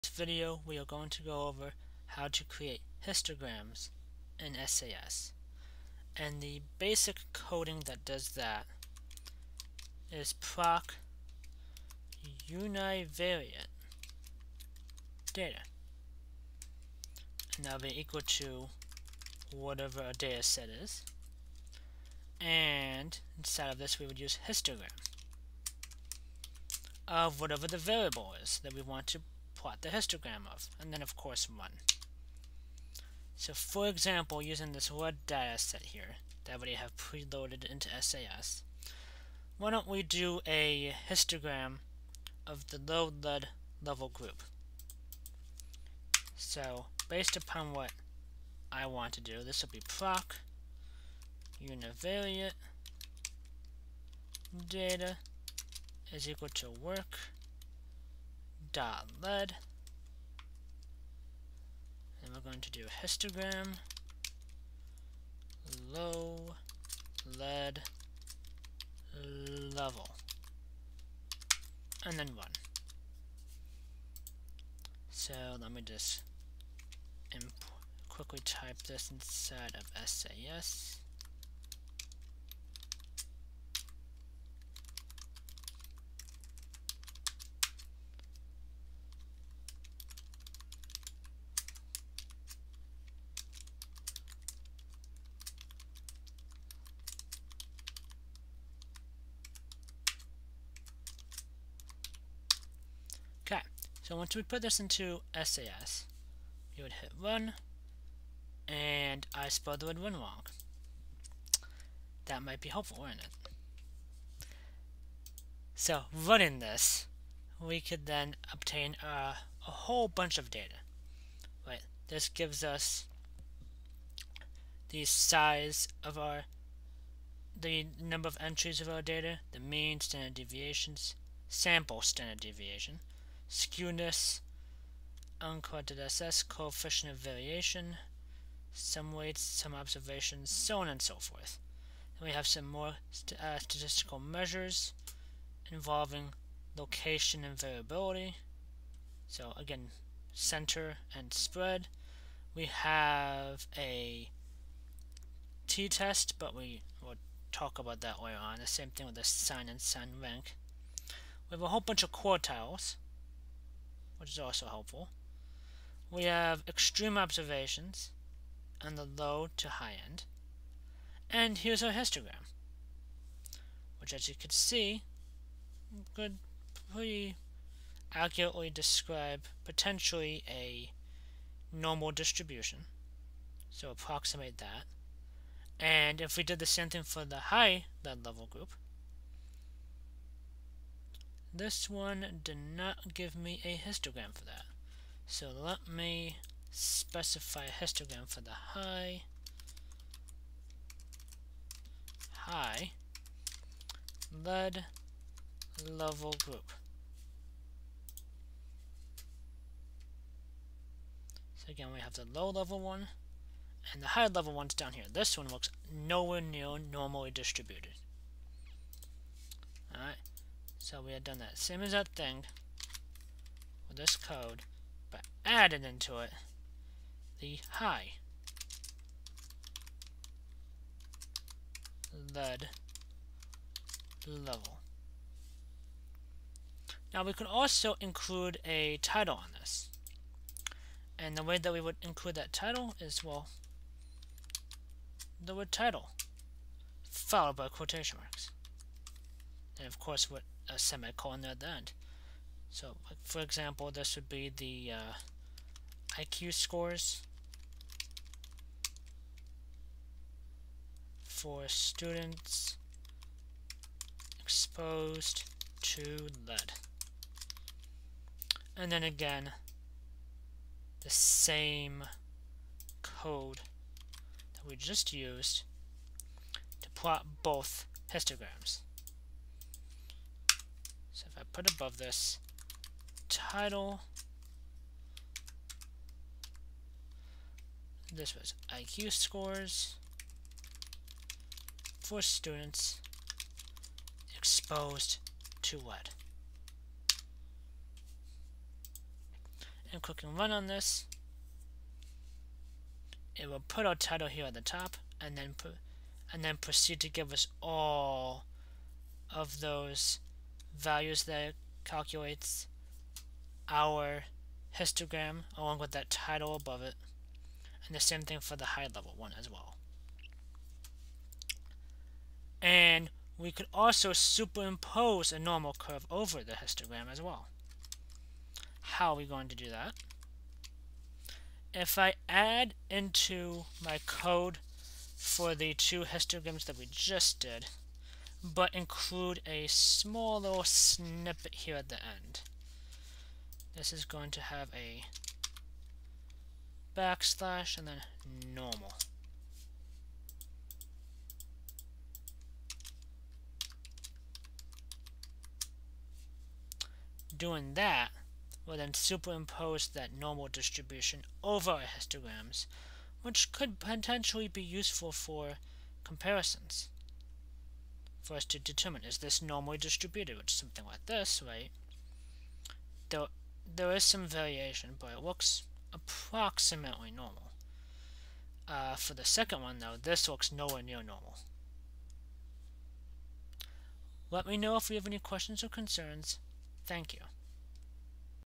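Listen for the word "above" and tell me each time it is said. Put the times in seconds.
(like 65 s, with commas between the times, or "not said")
281 s, 316 s.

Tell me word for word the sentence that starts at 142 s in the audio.
Then we have some more st uh, statistical measures involving location and variability.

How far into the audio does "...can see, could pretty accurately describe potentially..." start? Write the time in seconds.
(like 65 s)
174 s.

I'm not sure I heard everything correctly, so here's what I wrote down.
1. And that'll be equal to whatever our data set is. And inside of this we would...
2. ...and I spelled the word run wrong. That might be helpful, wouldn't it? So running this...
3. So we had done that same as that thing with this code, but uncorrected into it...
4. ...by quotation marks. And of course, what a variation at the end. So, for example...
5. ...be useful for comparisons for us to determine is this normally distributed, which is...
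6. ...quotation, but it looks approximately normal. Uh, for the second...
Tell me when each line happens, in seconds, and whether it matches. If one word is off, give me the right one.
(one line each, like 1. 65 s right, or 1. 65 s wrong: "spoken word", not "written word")
1. 17 s right
2. 108 s right
3. 220 s wrong: "added", not "uncorrected"
4. 247 s wrong: "semicolon", not "variation"
5. 364 s right
6. 374 s wrong: "variation", not "quotation".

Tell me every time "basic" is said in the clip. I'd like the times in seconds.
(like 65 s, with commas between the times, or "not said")
6 s.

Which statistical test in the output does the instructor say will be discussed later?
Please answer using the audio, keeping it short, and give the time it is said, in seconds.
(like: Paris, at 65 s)
t-test, at 155 s.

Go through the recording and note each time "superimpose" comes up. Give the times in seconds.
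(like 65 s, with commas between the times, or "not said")
324 s, 358 s.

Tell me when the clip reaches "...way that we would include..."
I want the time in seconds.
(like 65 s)
241 s.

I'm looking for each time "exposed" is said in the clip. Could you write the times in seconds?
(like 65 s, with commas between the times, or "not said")
264 s, 294 s.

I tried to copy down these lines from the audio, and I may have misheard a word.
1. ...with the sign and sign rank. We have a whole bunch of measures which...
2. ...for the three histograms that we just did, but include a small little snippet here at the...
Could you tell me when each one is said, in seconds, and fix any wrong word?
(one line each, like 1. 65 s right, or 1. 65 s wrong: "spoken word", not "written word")
1. 159 s wrong: "quartiles", not "measures"
2. 335 s wrong: "two", not "three".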